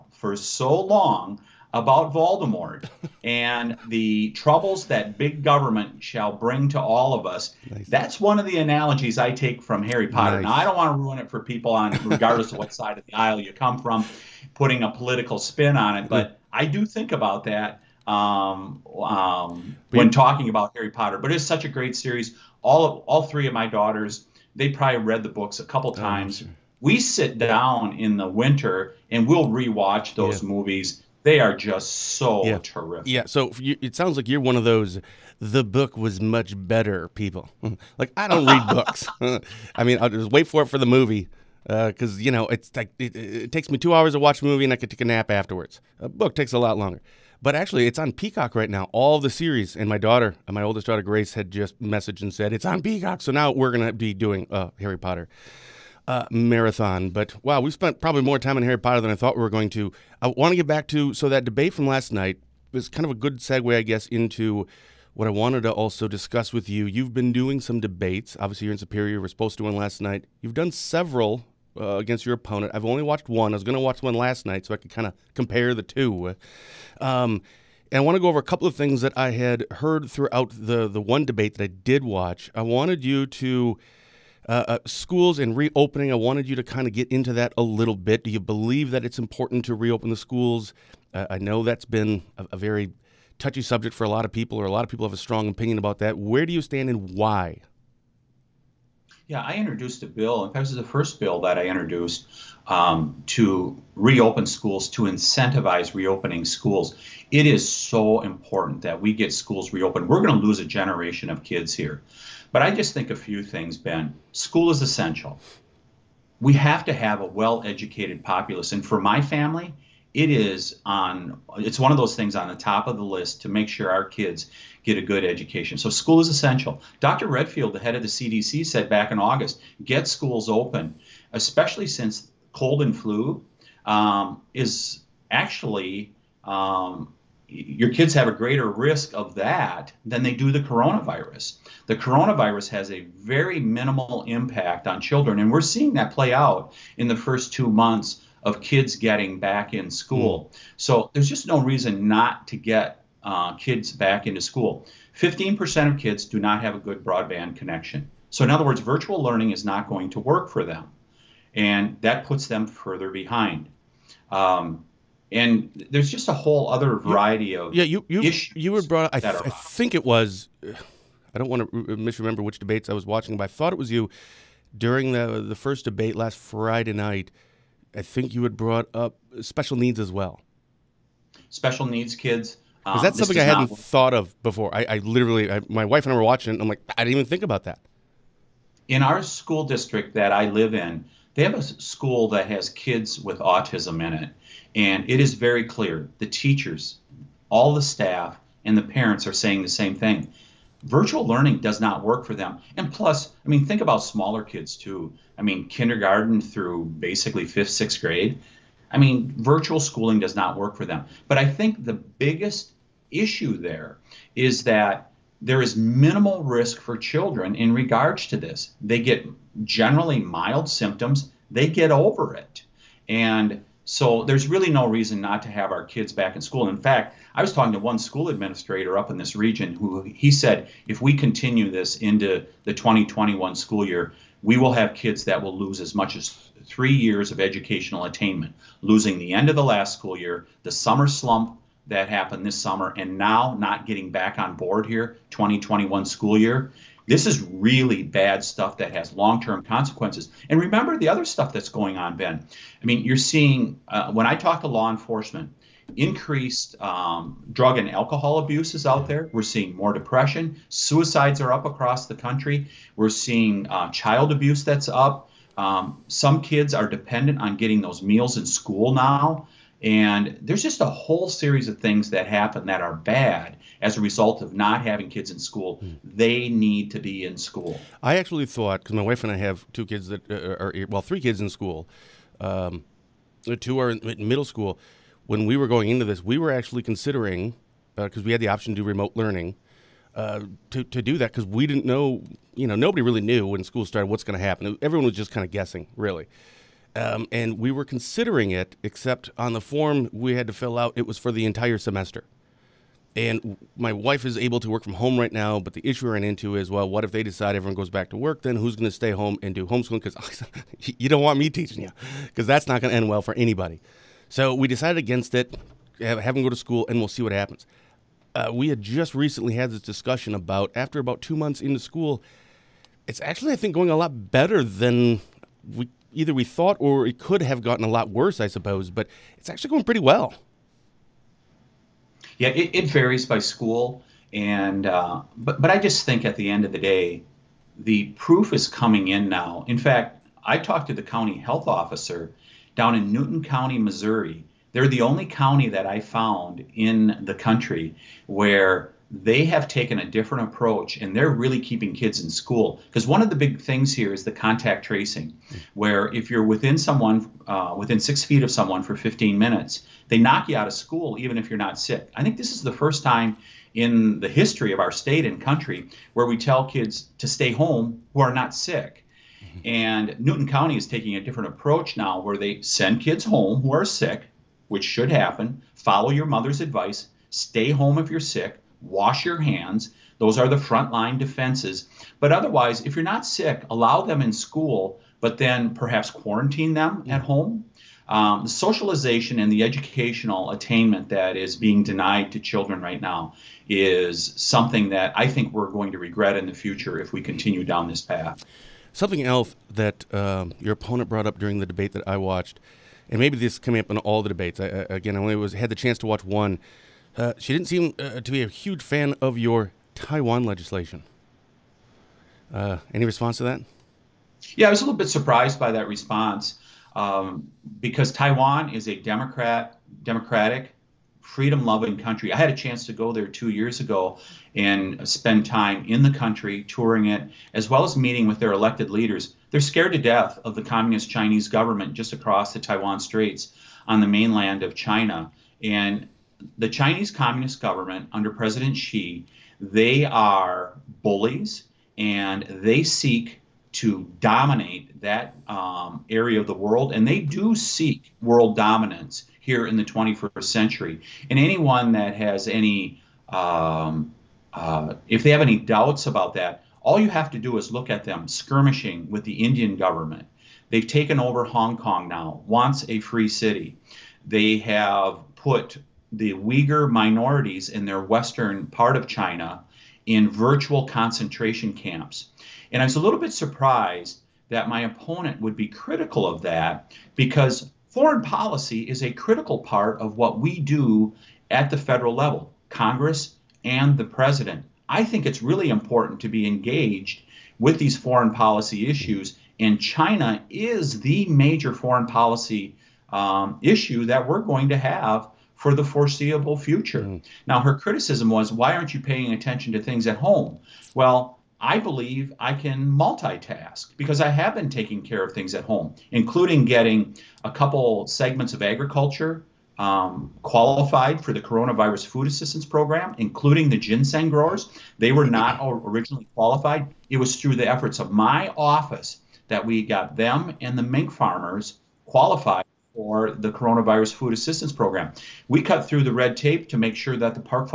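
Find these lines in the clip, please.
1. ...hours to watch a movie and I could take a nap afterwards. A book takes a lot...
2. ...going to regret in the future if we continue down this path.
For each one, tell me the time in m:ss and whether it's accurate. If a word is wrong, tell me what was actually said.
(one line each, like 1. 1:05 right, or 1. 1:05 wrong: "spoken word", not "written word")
1. 0:43 right
2. 6:35 right.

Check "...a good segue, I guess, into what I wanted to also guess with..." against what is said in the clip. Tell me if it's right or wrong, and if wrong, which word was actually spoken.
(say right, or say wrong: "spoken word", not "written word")
wrong: "discuss", not "guess".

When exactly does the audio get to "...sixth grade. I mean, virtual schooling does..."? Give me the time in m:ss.
3:27.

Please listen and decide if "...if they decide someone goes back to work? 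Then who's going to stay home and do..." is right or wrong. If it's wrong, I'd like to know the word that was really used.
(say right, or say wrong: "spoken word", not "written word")
wrong: "everyone", not "someone".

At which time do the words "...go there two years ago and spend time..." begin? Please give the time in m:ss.
7:02.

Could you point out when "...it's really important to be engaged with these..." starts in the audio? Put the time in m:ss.
8:05.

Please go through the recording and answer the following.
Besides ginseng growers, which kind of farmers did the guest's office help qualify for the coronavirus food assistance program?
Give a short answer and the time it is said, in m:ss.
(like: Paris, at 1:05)
mink farmers, at 8:40.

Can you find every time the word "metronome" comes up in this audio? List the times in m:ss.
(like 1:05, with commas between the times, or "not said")
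not said.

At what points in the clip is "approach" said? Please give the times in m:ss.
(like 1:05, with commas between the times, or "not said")
5:50, 6:11.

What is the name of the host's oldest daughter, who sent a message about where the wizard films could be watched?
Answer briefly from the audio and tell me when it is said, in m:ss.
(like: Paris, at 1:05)
Grace, at 0:51.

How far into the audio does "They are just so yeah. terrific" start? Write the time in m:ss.
0:31.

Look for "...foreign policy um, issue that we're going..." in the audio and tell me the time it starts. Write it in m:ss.
8:11.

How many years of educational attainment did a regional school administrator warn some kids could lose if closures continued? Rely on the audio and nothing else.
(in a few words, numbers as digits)
3 years.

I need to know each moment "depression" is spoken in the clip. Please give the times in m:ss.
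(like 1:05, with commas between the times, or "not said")
4:19.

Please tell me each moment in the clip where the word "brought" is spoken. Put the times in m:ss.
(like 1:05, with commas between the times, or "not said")
2:48, 2:58, 6:41.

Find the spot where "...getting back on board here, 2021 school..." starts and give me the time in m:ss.
4:03.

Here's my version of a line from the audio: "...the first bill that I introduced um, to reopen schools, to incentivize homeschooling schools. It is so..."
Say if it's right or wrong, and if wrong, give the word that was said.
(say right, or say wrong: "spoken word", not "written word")
wrong: "reopening", not "homeschooling".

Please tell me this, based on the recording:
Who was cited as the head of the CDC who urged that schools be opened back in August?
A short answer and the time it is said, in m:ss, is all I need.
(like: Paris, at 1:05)
Dr. 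Redfield, at 2:06.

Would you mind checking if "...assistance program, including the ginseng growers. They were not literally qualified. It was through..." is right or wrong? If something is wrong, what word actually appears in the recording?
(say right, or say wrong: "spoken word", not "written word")
wrong: "originally", not "literally".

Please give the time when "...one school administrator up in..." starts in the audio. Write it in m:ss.
3:47.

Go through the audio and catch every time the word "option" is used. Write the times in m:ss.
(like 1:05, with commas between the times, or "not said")
4:48.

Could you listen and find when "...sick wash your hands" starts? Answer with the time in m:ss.
6:18.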